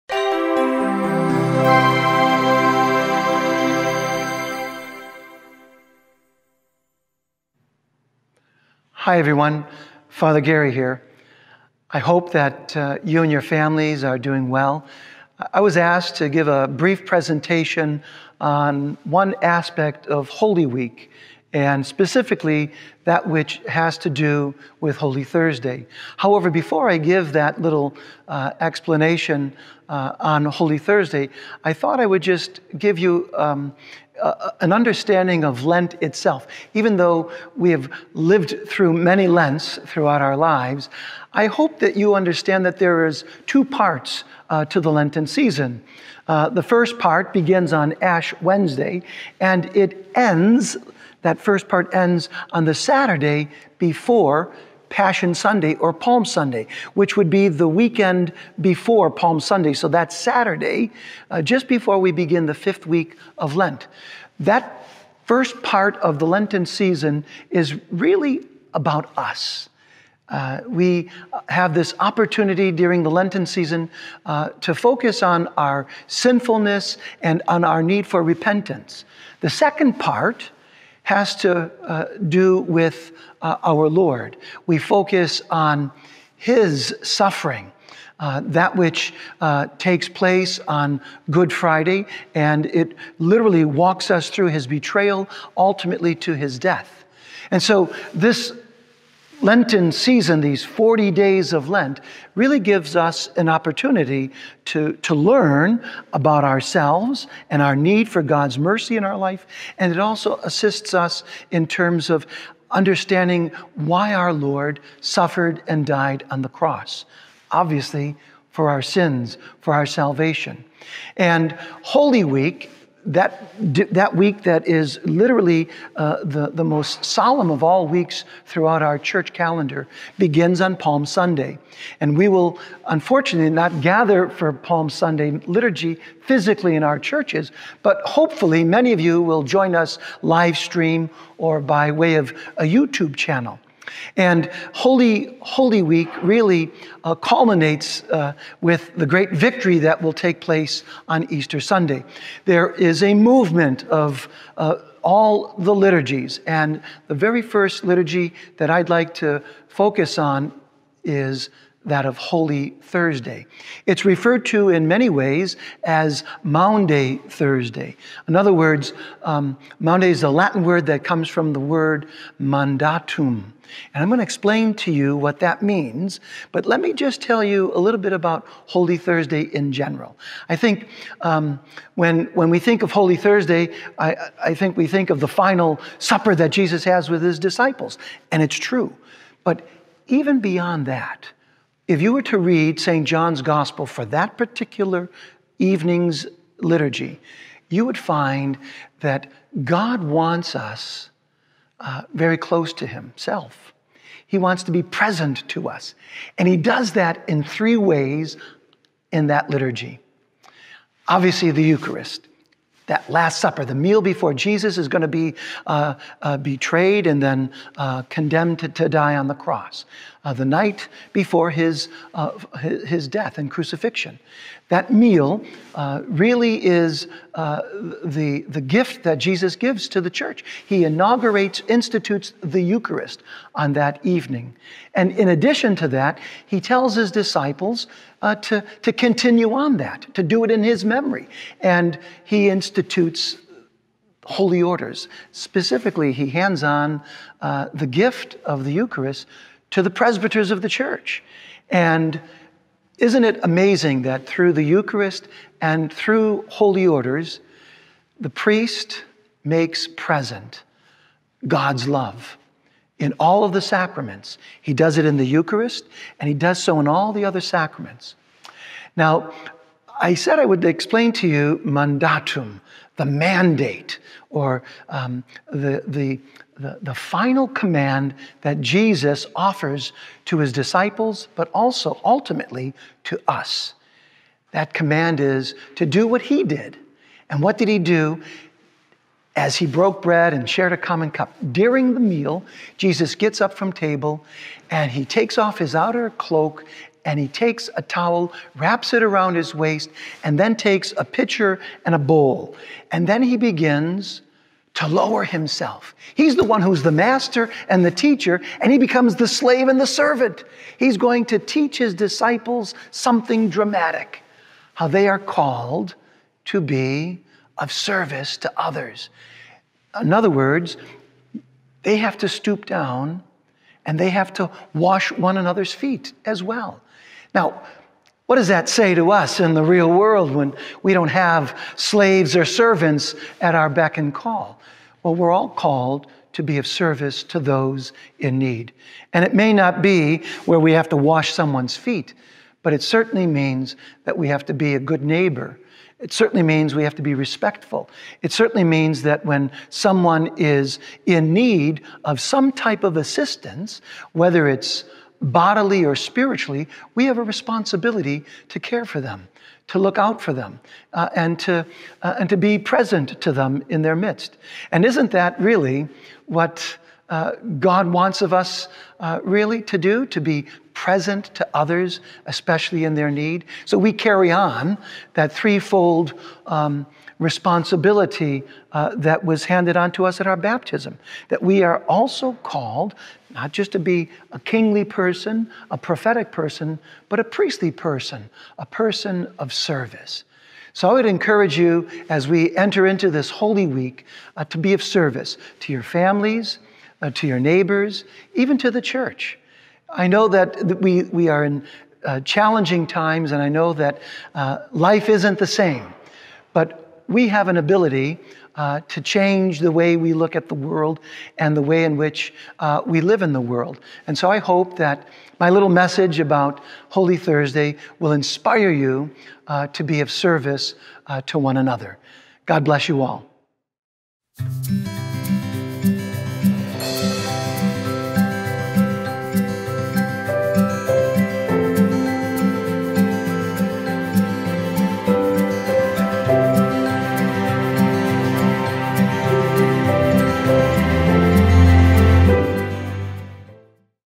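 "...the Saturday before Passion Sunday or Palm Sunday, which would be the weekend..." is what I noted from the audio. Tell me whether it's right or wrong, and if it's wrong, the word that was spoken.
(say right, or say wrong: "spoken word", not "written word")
right.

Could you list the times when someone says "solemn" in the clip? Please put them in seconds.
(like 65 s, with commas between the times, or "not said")
127 s.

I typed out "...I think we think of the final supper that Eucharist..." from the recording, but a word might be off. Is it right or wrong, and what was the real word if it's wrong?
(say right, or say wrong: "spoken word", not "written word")
wrong: "Jesus", not "Eucharist".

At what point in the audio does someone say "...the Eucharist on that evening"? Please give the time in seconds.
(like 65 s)
232 s.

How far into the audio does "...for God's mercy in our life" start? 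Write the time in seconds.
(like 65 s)
108 s.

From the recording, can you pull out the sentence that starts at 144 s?
And Holy, Holy Week really uh, culminates uh, with the great victory that will take place on Easter Sunday.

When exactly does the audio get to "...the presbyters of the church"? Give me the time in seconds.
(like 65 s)
249 s.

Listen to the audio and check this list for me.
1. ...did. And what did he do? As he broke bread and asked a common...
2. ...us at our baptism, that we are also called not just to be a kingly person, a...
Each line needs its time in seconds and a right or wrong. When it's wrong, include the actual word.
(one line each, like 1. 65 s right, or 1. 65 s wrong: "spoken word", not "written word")
1. 286 s wrong: "shared", not "asked"
2. 380 s right.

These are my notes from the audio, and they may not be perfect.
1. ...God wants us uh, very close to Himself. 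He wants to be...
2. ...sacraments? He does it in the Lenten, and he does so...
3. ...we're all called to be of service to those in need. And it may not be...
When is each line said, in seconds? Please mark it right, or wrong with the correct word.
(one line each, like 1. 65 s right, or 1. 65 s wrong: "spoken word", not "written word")
1. 199 s right
2. 263 s wrong: "Eucharist", not "Lenten"
3. 335 s right.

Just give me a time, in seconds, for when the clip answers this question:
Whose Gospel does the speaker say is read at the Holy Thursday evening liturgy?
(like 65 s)
192 s.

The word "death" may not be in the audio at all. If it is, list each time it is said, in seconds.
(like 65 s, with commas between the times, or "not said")
96 s, 223 s.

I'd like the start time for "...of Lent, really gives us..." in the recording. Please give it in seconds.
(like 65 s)
101 s.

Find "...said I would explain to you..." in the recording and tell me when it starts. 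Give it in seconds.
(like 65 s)
270 s.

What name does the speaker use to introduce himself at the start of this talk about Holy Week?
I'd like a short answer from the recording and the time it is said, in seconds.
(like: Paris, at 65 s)
Father Gary, at 10 s.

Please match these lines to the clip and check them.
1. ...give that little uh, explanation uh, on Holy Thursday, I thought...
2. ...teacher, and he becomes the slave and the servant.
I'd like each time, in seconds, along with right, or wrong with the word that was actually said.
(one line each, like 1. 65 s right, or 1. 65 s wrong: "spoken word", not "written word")
1. 26 s right
2. 307 s right.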